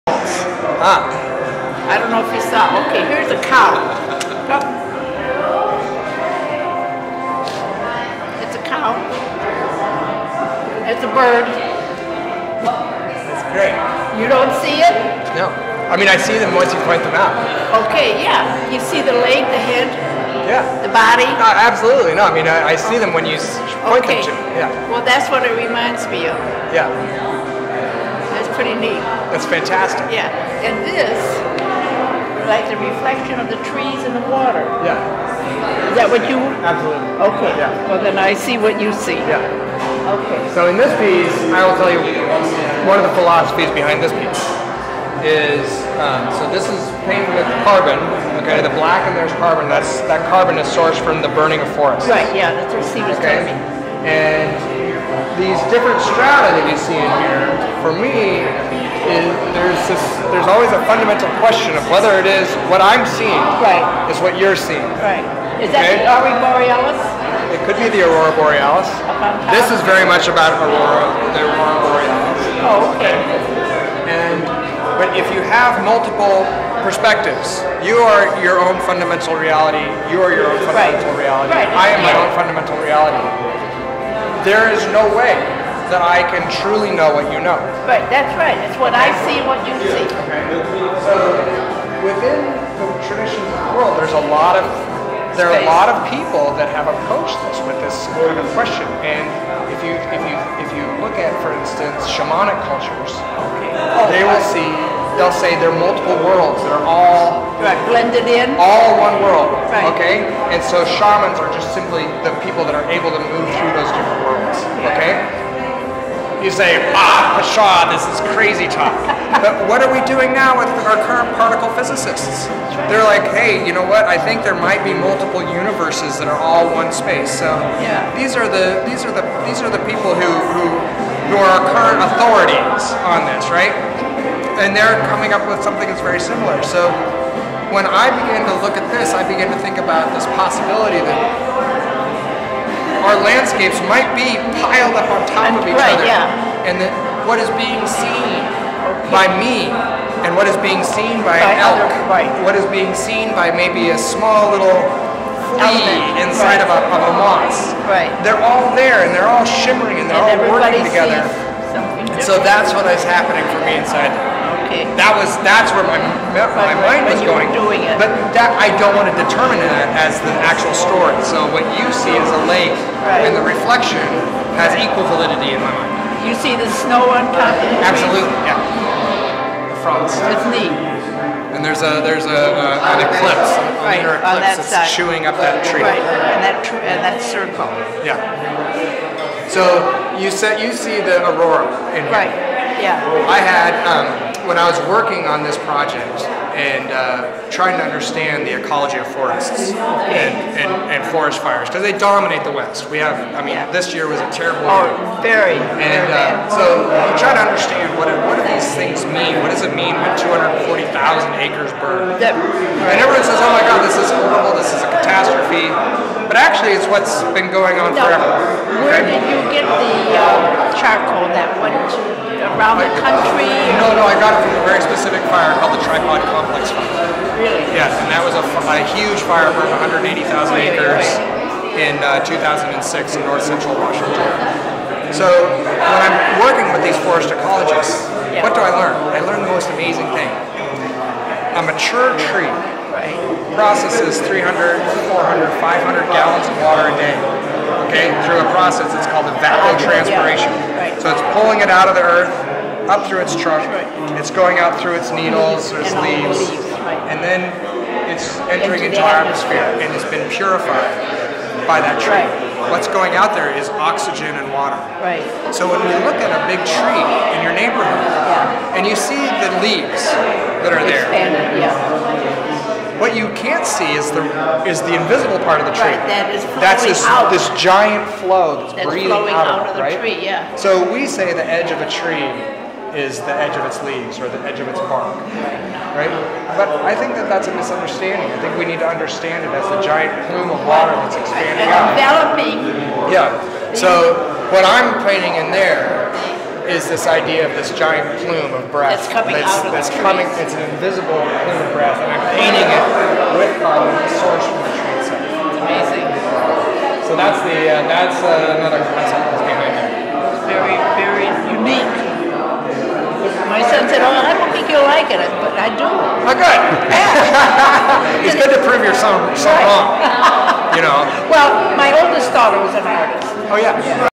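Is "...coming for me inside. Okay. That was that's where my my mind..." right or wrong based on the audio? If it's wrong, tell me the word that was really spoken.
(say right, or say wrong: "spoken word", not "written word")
wrong: "happening", not "coming".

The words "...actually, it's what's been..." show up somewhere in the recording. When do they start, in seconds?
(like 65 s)
216 s.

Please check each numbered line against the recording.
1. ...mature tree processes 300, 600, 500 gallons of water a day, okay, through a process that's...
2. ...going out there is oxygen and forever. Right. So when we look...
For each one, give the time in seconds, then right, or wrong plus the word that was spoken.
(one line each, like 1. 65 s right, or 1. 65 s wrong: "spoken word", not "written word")
1. 241 s wrong: "400", not "600"
2. 262 s wrong: "water", not "forever".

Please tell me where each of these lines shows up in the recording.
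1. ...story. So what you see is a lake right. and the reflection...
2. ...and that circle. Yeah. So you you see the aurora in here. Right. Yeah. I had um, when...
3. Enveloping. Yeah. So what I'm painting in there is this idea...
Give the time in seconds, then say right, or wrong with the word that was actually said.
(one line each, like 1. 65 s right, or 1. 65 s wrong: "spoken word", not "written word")
1. 170 s right
2. 186 s right
3. 292 s right.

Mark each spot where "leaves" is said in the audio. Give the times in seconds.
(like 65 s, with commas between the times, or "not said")
255 s, 269 s, 283 s.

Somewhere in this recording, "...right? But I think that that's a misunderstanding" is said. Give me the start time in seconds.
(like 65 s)
285 s.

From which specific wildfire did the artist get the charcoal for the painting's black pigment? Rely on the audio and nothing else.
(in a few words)
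Tripod Complex Fire.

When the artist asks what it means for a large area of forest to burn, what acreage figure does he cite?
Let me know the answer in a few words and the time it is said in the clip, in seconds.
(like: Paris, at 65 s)
240,000 acres, at 210 s.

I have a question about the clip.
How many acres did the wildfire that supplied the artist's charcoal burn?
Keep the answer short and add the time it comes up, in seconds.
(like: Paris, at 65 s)
180,000, at 229 s.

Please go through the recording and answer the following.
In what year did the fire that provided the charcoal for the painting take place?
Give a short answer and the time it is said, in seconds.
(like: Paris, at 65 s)
2006, at 232 s.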